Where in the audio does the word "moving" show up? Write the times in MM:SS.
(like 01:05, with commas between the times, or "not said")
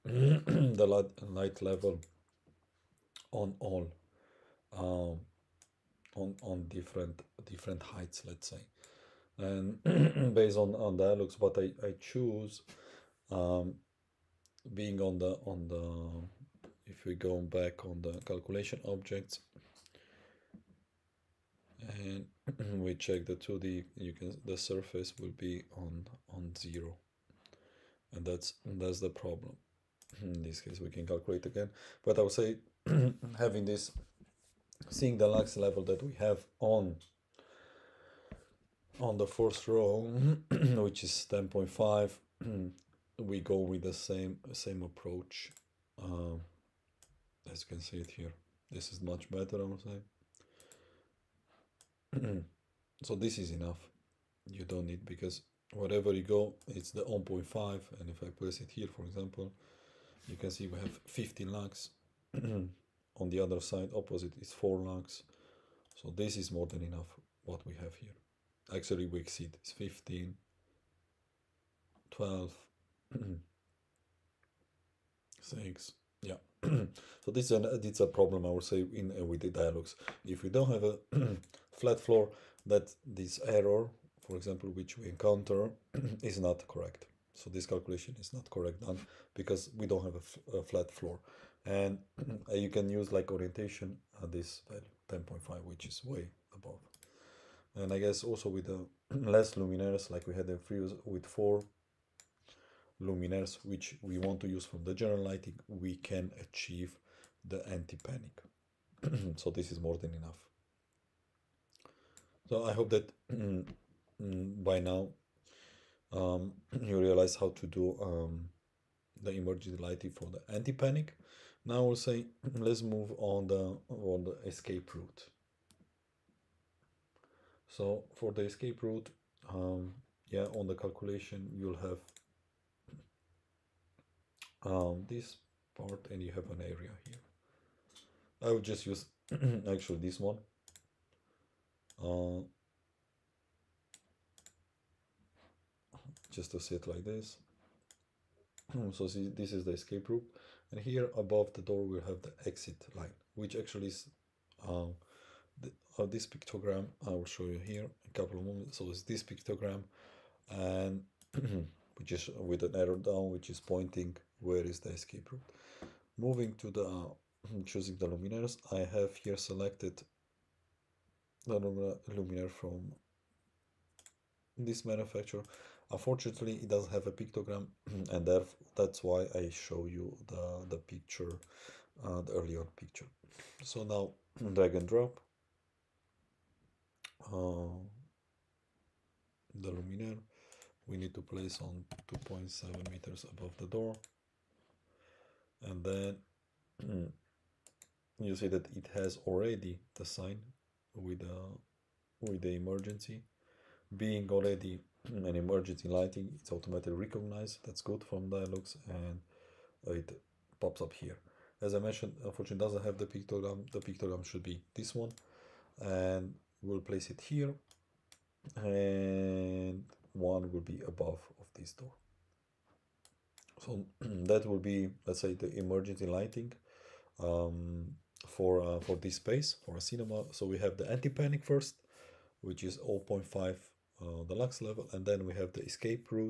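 02:46.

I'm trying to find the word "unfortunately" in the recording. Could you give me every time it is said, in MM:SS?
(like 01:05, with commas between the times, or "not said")
02:55, 03:32.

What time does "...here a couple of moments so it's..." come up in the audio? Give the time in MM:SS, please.
02:37.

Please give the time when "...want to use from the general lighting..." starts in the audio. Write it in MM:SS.
01:44.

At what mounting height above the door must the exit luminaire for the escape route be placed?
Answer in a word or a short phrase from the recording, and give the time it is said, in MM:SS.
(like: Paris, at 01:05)
2.7 meters, at 03:12.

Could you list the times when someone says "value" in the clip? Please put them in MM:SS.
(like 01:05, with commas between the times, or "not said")
01:34.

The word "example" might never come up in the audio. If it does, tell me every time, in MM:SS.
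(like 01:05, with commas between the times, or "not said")
00:59, 01:24.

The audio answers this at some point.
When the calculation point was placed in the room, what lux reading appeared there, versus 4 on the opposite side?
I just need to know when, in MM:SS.
01:01.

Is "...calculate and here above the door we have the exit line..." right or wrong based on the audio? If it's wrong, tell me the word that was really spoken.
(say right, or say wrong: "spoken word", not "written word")
wrong: "route", not "calculate".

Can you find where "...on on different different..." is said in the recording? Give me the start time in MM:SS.
00:06.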